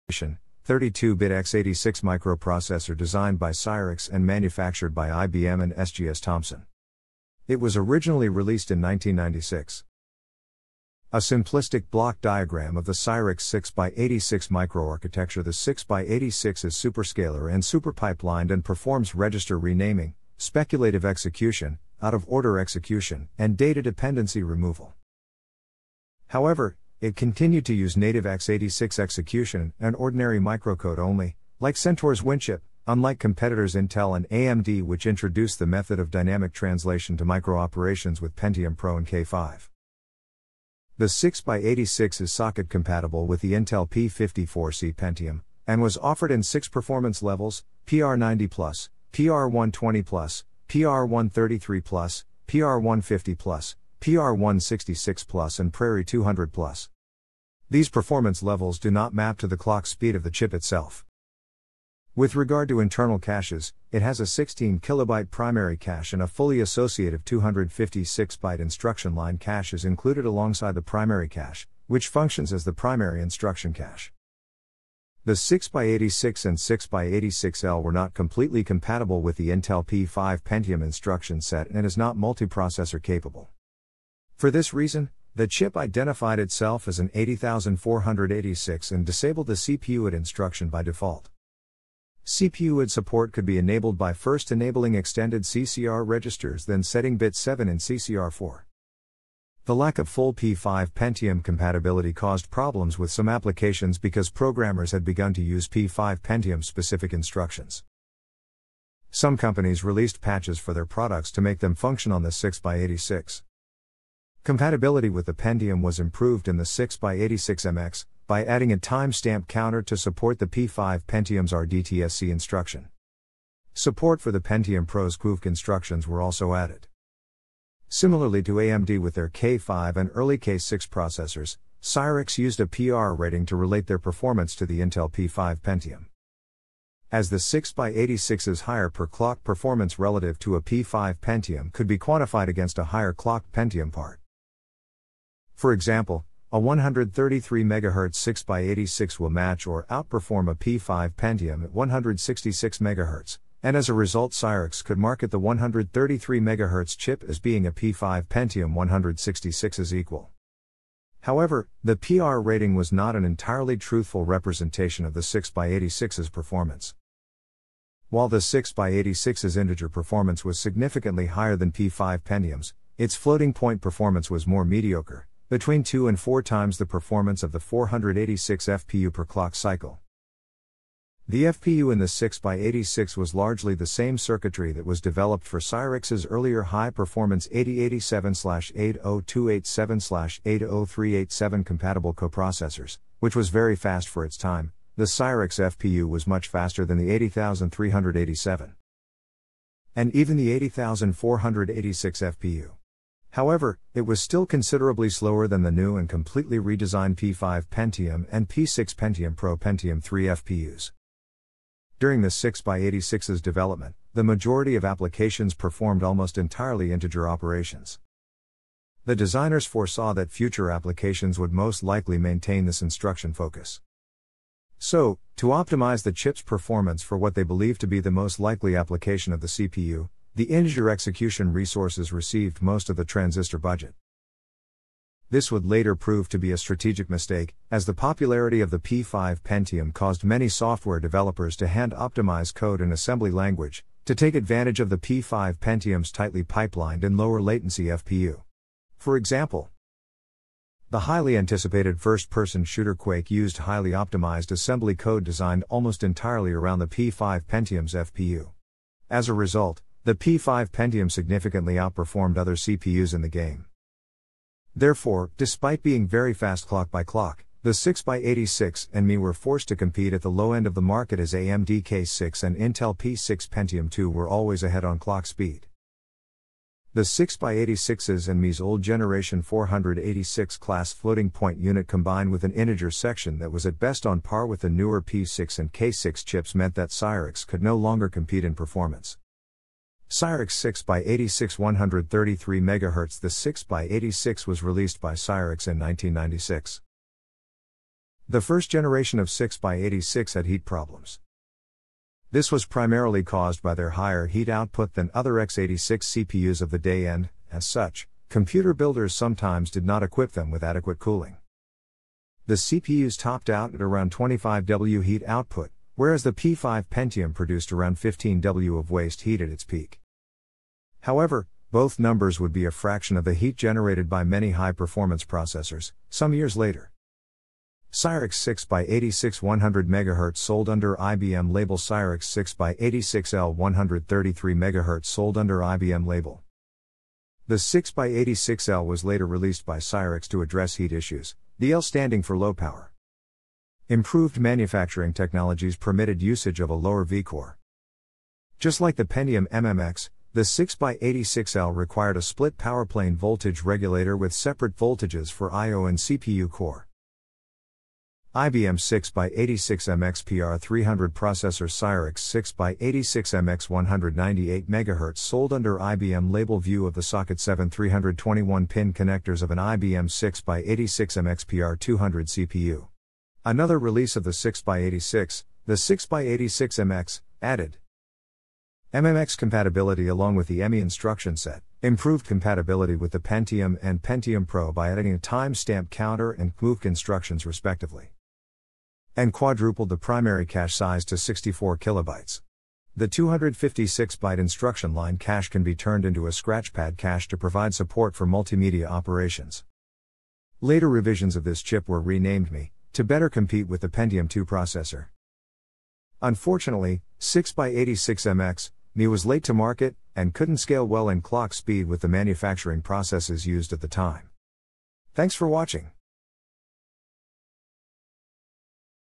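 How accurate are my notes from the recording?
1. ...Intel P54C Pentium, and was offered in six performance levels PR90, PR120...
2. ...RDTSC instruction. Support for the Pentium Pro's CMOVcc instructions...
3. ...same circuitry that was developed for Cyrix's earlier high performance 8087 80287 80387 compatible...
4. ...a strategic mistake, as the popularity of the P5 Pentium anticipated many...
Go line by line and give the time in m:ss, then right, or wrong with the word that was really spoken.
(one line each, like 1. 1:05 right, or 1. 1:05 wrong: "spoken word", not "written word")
1. 0:43 right
2. 2:01 right
3. 3:03 right
4. 3:56 wrong: "caused", not "anticipated".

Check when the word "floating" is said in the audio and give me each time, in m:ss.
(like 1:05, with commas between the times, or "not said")
2:53, 4:40.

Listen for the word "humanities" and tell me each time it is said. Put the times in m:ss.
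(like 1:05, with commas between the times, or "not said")
not said.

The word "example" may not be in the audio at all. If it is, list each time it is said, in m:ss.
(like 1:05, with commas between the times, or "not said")
2:25, 4:09.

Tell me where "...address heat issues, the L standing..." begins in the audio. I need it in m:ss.
5:40.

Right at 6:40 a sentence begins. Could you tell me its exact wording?
Later revisions of this chip were renamed MII to better compete with the Pentium 2 processor.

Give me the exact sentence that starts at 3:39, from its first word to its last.
The designers foresaw that future applications would most likely maintain this instruction focus.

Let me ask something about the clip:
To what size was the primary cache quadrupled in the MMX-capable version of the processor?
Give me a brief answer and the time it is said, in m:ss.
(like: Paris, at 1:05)
64 kilobytes, at 6:31.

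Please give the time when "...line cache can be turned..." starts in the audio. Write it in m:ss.
6:34.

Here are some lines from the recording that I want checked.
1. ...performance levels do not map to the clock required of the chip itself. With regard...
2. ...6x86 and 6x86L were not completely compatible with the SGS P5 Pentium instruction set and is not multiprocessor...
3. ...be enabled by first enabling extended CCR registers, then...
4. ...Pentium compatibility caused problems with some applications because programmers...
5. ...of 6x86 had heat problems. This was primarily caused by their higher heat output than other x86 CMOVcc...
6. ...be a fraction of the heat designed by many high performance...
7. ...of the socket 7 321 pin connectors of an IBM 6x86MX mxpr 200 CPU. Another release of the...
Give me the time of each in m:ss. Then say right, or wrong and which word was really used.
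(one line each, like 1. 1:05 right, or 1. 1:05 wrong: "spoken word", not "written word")
1. 0:57 wrong: "speed", not "required"
2. 1:15 wrong: "Intel", not "SGS"
3. 1:33 right
4. 1:40 right
5. 4:59 wrong: "CPUs", not "CMOVcc"
6. 5:22 wrong: "generated", not "designed"
7. 6:06 right.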